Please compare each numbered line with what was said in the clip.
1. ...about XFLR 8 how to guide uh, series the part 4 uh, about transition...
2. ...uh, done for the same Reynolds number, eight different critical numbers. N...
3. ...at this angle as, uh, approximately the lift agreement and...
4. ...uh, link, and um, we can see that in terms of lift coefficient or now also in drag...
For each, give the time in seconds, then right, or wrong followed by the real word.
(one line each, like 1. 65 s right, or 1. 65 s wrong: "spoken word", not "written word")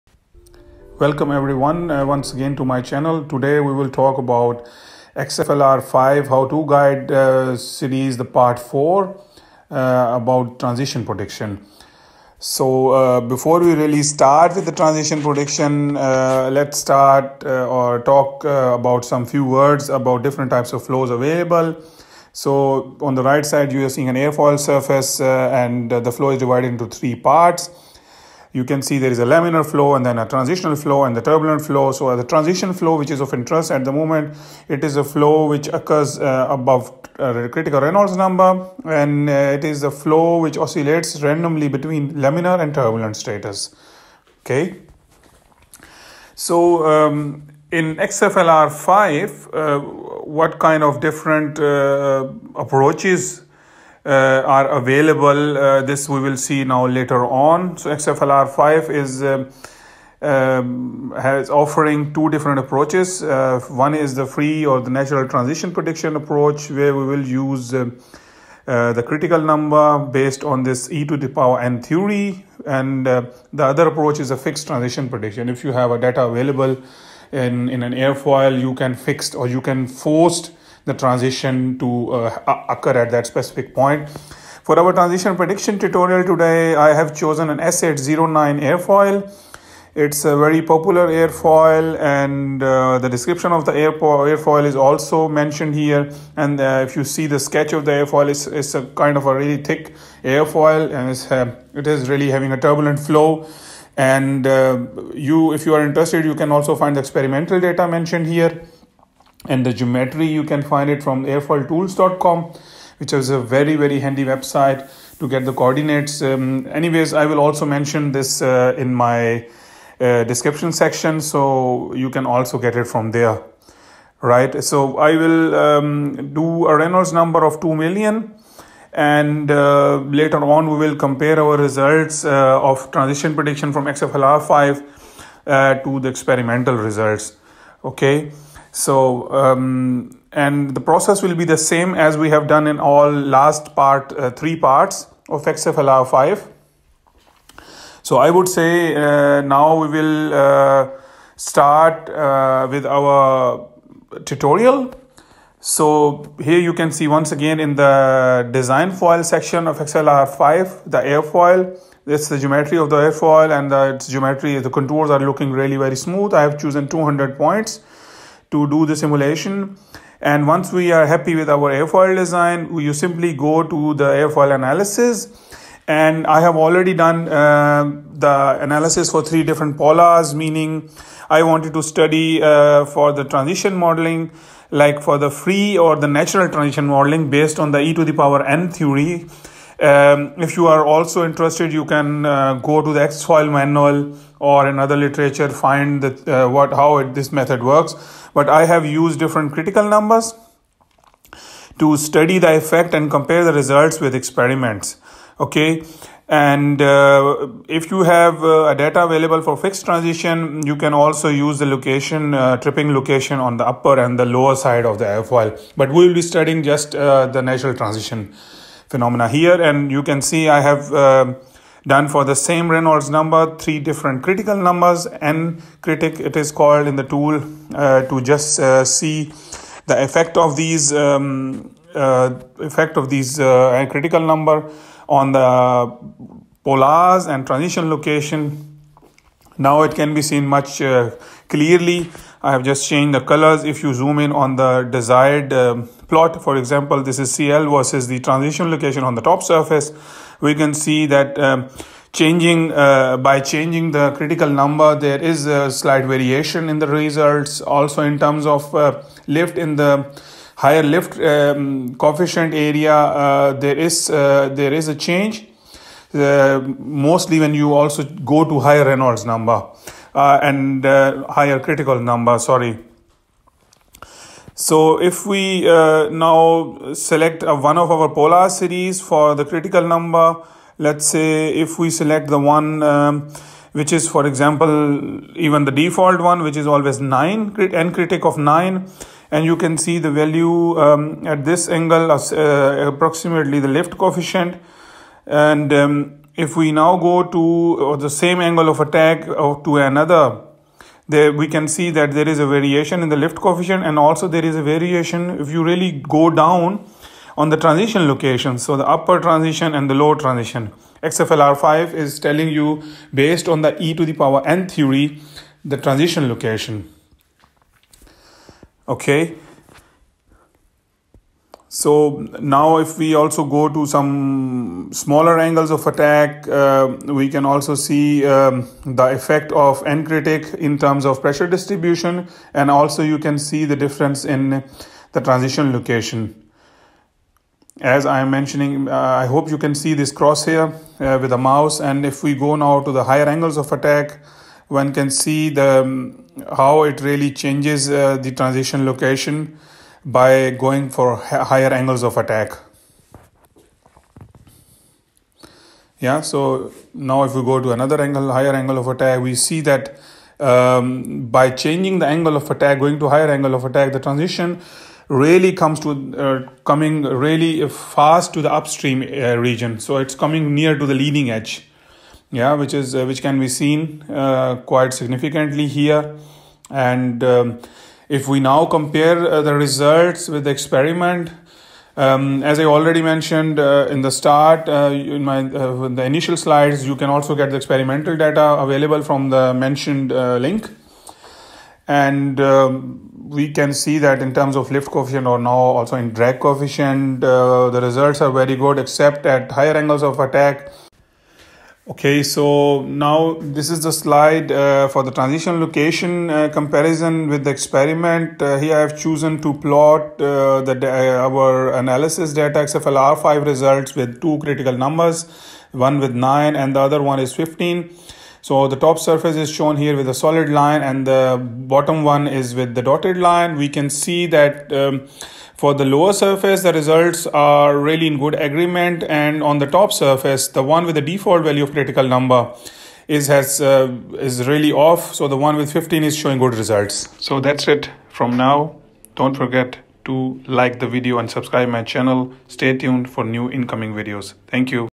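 1. 4 s wrong: "5", not "8"
2. 220 s wrong: "three", not "eight"
3. 291 s wrong: "coefficient", not "agreement"
4. 390 s right.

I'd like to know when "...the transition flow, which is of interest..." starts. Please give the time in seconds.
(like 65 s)
32 s.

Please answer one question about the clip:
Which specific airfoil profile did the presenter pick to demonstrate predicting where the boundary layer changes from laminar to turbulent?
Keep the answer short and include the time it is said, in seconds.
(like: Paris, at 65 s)
S809, at 87 s.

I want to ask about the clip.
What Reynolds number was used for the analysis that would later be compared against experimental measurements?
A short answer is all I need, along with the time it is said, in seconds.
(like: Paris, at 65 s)
2 million, at 127 s.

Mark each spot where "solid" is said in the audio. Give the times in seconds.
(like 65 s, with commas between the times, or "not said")
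420 s.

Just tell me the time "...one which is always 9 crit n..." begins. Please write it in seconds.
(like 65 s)
286 s.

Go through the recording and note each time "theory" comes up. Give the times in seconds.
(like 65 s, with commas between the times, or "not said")
71 s, 188 s, 314 s.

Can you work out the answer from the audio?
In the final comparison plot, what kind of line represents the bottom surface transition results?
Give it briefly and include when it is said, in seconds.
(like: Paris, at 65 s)
dotted line, at 422 s.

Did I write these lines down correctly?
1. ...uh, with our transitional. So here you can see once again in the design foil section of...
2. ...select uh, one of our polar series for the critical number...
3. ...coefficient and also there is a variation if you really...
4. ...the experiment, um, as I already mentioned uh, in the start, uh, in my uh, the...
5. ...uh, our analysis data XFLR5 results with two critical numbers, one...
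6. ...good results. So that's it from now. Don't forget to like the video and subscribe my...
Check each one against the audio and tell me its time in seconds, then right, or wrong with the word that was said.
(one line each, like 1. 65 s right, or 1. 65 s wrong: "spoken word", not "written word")
1. 152 s wrong: "tutorial", not "transitional"
2. 276 s right
3. 303 s right
4. 380 s right
5. 410 s right
6. 436 s right.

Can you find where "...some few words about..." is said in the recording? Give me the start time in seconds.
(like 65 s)
19 s.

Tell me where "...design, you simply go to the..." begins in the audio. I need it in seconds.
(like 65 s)
172 s.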